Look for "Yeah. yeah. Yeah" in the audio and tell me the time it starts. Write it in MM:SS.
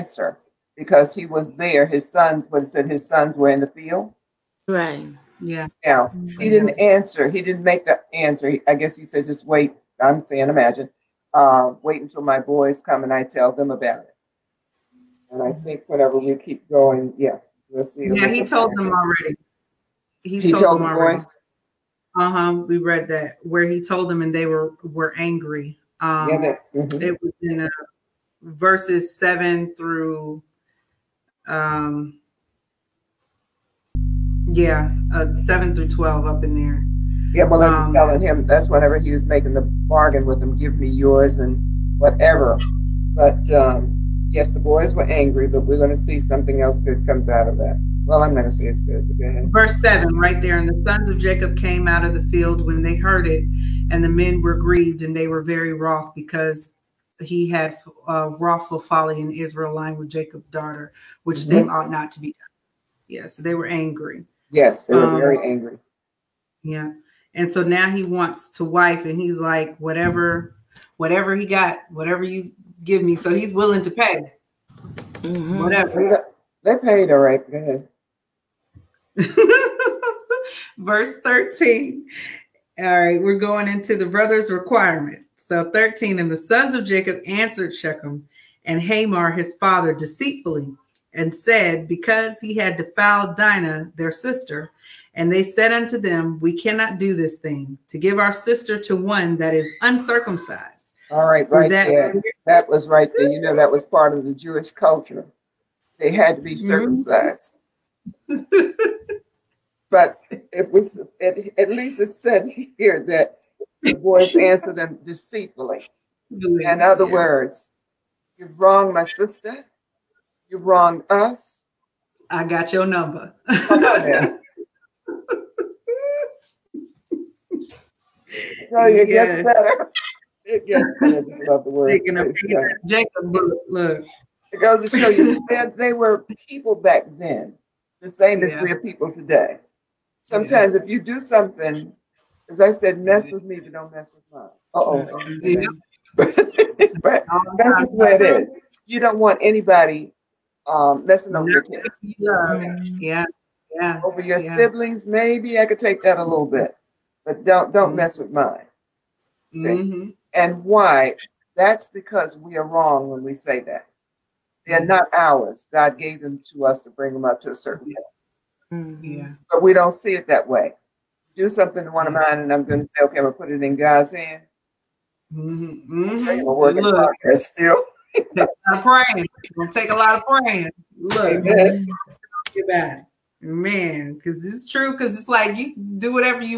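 02:32.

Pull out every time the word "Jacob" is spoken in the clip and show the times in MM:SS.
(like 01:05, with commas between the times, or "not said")
00:51, 01:00, 01:26, 02:12.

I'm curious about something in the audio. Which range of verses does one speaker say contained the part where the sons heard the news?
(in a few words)
7 through 12.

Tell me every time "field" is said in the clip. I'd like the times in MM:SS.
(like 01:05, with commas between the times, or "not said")
00:03, 00:52.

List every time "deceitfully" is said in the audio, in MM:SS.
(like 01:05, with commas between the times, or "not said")
01:29, 01:55.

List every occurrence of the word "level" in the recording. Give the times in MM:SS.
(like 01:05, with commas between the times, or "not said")
02:47.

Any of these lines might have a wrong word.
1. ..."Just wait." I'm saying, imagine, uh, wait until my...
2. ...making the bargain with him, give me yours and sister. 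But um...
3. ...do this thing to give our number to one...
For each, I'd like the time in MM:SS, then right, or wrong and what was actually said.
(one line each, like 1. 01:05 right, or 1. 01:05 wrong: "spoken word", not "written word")
1. 00:09 right
2. 00:39 wrong: "whatever", not "sister"
3. 01:36 wrong: "sister", not "number".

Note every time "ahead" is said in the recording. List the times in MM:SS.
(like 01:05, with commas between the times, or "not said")
00:49, 01:17.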